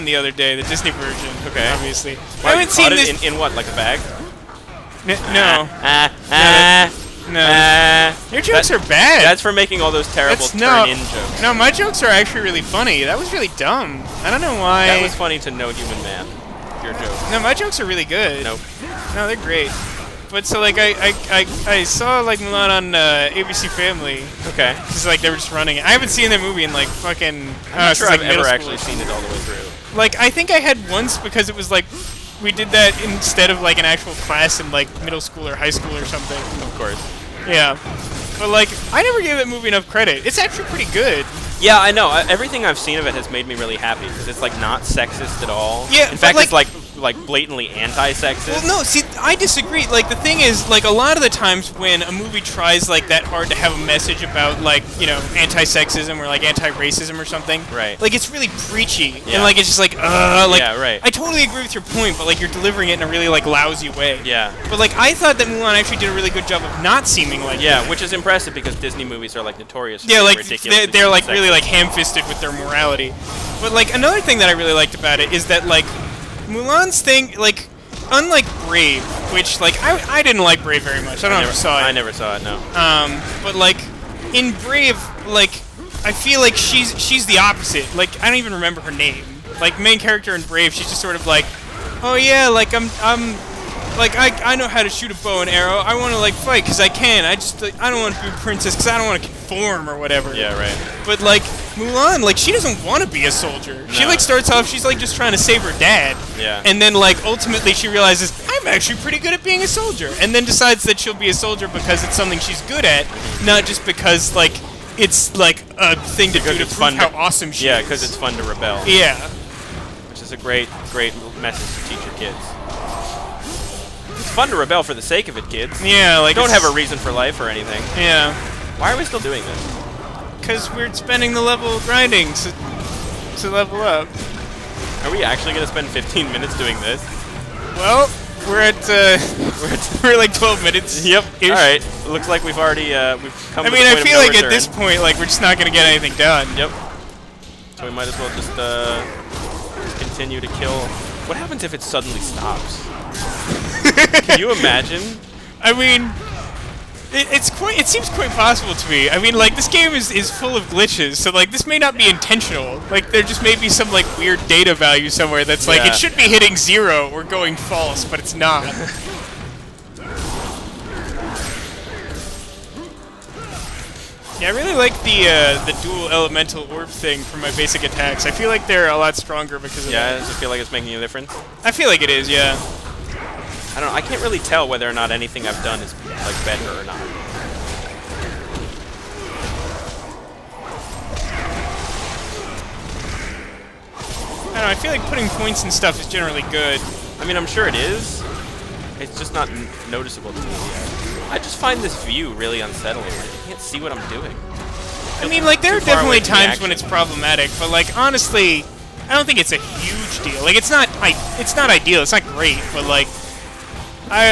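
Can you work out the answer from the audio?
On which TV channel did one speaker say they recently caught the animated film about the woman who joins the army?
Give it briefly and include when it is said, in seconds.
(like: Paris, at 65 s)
ABC Family, at 23 s.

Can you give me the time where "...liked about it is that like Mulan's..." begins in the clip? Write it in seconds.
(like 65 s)
74 s.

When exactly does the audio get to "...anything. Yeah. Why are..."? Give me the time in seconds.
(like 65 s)
127 s.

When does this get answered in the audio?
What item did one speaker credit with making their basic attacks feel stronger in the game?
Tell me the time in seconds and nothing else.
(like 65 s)
175 s.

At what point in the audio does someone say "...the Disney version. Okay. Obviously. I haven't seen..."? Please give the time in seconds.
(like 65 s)
0 s.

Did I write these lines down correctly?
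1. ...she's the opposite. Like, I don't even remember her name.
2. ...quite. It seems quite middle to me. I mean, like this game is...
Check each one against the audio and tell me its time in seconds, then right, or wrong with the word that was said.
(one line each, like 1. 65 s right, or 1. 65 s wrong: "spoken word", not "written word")
1. 87 s right
2. 157 s wrong: "possible", not "middle".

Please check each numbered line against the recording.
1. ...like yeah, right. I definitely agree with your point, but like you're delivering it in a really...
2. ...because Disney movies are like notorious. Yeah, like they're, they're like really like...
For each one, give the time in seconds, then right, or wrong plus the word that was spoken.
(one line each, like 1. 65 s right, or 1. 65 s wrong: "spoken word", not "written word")
1. 60 s wrong: "totally", not "definitely"
2. 68 s right.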